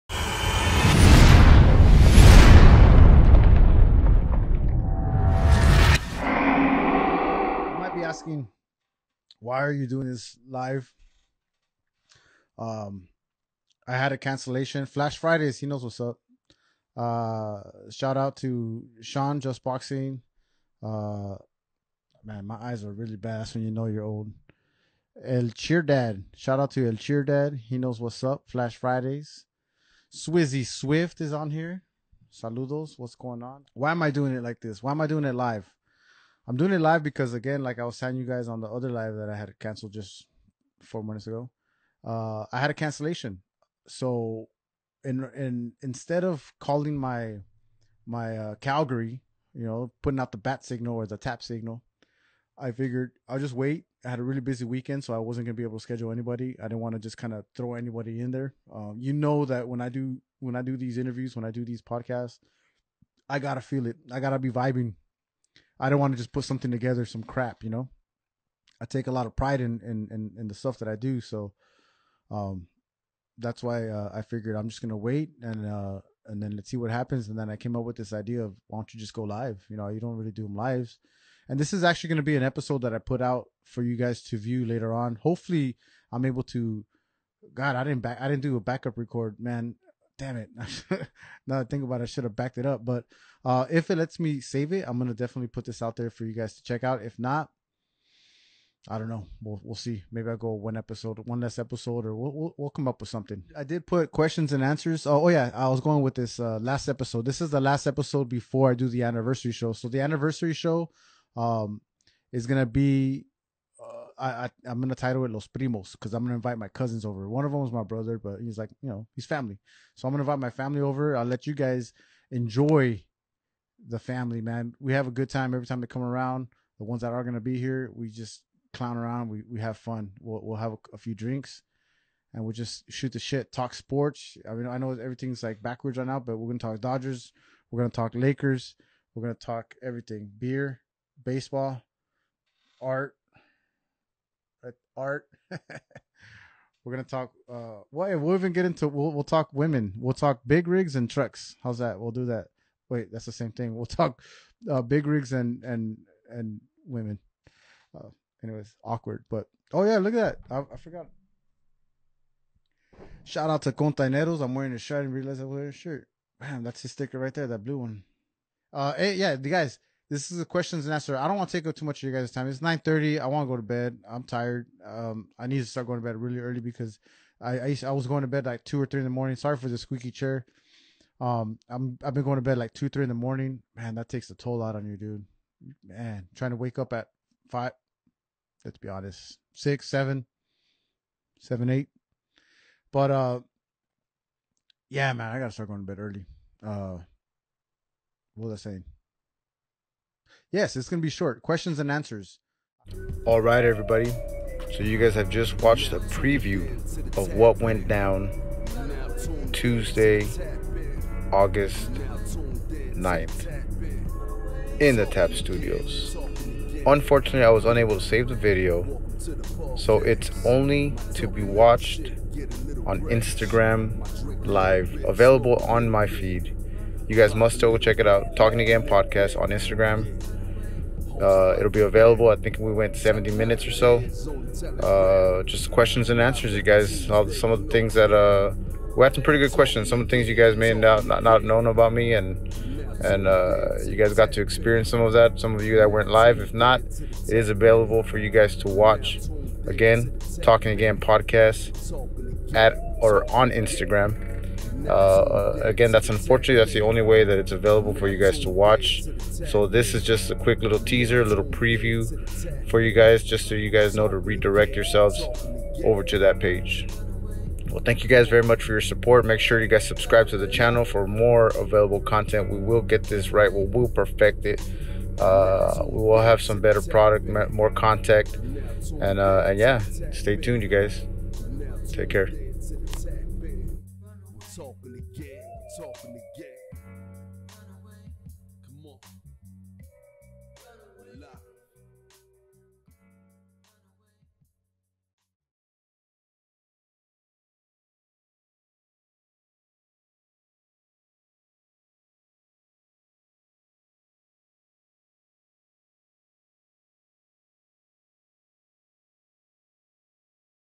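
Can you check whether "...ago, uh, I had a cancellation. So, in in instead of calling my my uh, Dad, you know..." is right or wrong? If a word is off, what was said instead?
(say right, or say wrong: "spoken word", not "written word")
wrong: "Calgary", not "Dad".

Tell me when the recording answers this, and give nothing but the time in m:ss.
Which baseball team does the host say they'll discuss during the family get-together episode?
2:16.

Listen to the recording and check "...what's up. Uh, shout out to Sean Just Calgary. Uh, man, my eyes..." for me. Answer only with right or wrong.
wrong.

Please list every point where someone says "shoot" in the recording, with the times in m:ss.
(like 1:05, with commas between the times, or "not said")
2:12.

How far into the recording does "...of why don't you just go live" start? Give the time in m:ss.
1:18.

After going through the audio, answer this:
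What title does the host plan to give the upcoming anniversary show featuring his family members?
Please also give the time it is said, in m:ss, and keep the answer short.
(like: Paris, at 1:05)
Los Primos, at 1:55.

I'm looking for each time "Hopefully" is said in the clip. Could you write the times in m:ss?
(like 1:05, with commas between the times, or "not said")
1:25.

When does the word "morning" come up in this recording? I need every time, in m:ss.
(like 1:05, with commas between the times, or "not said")
2:59, 3:03.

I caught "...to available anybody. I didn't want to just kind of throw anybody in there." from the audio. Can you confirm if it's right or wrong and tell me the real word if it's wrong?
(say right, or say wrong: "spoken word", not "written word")
wrong: "schedule", not "available".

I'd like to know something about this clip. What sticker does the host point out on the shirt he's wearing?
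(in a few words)
Containeros.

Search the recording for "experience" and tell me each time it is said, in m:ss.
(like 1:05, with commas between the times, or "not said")
4:04.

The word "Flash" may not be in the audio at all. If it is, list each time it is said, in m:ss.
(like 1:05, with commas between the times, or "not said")
0:14, 0:28.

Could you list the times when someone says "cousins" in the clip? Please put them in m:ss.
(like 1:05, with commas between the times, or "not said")
1:56.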